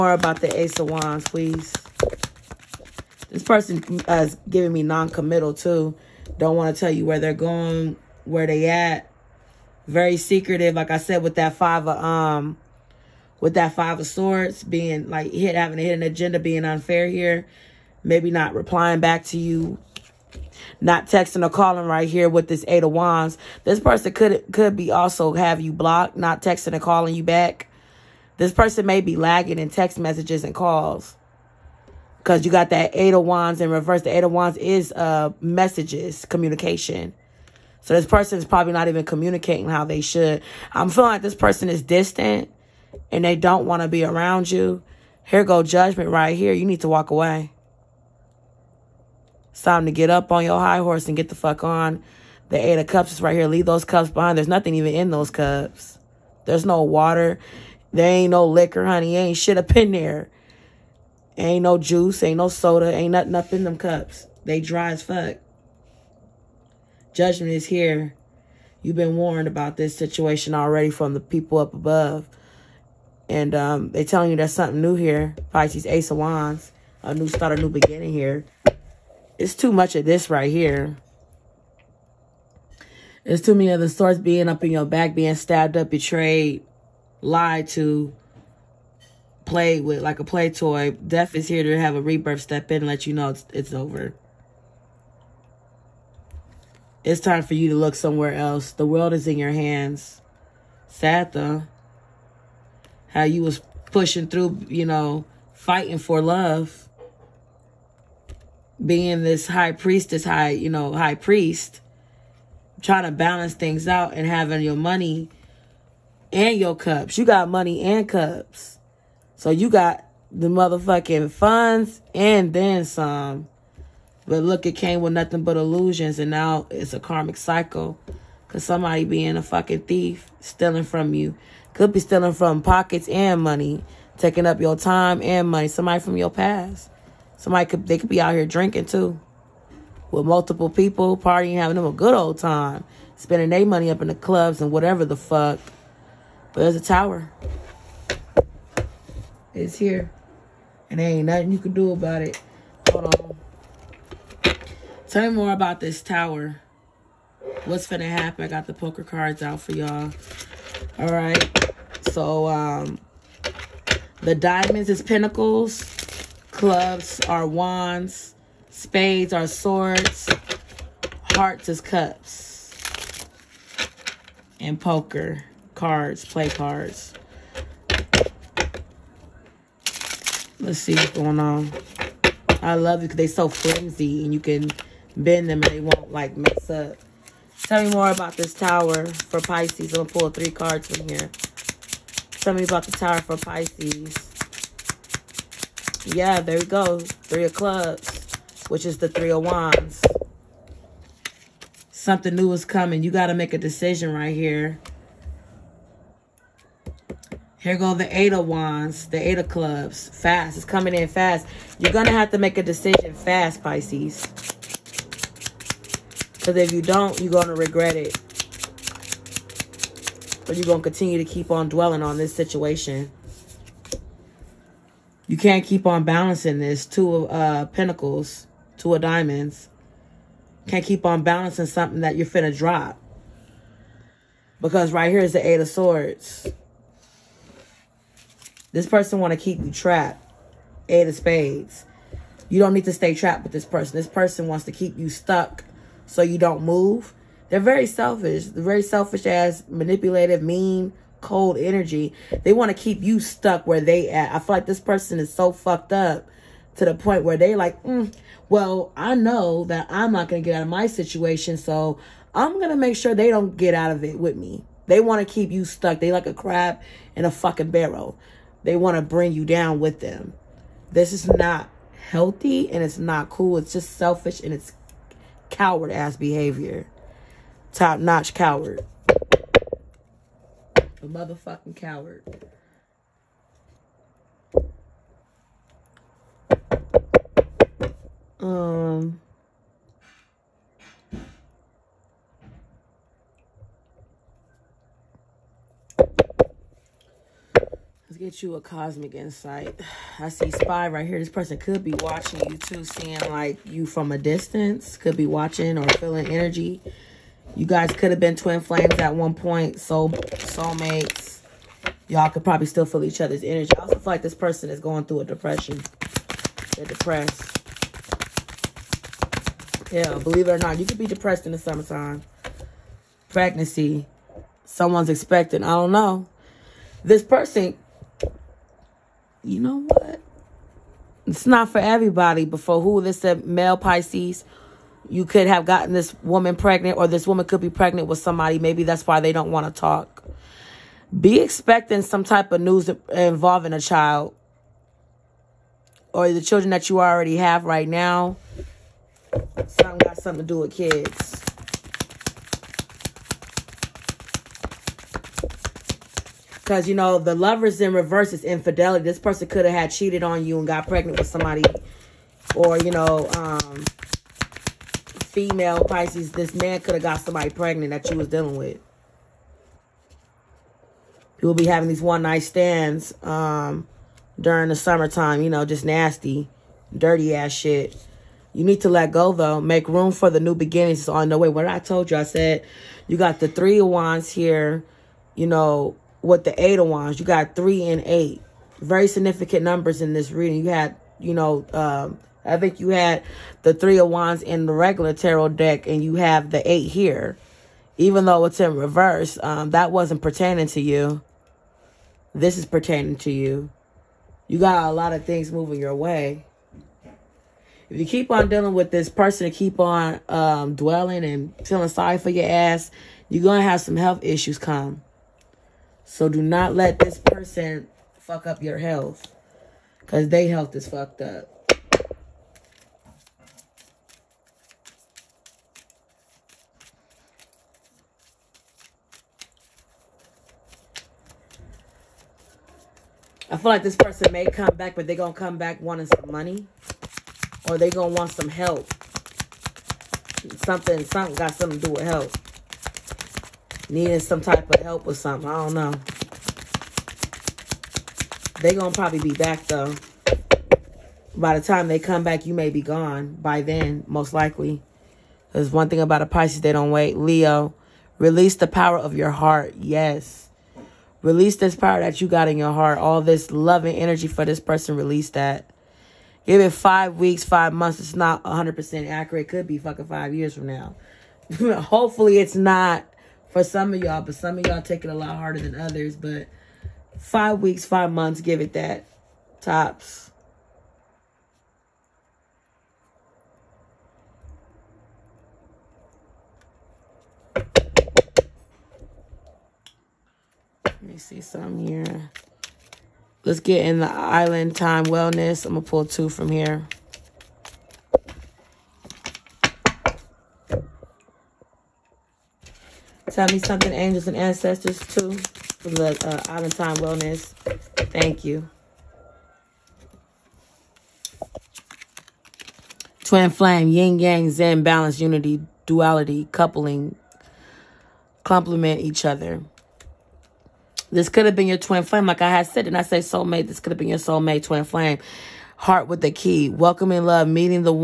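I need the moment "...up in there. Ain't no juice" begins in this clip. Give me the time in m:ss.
0:59.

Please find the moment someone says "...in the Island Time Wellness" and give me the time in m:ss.
8:13.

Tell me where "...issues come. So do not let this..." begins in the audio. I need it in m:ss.
6:54.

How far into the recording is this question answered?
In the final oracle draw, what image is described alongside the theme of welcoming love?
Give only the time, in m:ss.
8:45.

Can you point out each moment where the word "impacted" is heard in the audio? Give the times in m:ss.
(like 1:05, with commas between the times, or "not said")
not said.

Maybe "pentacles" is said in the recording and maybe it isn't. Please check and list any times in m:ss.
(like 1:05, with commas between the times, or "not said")
2:45, 3:47.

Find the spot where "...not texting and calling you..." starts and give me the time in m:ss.
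0:26.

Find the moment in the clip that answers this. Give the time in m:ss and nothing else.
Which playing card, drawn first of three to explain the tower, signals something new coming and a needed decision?
3:17.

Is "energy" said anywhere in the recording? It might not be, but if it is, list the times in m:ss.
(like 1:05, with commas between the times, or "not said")
4:11, 5:06, 5:13, 7:43.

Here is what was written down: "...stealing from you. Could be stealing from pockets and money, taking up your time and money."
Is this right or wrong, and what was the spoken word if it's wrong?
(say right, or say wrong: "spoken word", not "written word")
right.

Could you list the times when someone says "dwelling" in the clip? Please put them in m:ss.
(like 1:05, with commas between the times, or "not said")
3:41, 6:50.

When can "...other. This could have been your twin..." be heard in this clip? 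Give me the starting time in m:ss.
8:39.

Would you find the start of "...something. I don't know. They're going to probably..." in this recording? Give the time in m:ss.
7:25.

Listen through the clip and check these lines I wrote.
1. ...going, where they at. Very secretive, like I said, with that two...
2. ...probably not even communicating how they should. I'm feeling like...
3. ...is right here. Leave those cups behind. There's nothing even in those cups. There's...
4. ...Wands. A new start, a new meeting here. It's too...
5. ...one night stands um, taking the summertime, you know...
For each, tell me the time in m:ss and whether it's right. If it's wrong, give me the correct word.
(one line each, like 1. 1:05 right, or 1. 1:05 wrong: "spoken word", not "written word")
1. 0:07 wrong: "five", not "two"
2. 0:38 right
3. 0:53 right
4. 1:16 wrong: "beginning", not "meeting"
5. 6:12 wrong: "during", not "taking".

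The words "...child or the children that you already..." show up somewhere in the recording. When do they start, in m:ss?
5:43.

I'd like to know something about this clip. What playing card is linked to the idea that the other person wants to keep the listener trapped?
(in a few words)
Eight of spades.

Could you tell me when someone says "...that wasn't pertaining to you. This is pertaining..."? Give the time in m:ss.
6:39.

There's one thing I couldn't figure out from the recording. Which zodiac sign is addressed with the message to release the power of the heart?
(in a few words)
Leo.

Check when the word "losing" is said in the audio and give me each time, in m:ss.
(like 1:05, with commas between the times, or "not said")
not said.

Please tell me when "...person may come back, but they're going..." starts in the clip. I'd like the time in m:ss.
7:13.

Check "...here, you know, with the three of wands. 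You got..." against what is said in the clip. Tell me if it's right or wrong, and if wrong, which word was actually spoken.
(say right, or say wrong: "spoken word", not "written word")
wrong: "eight", not "three".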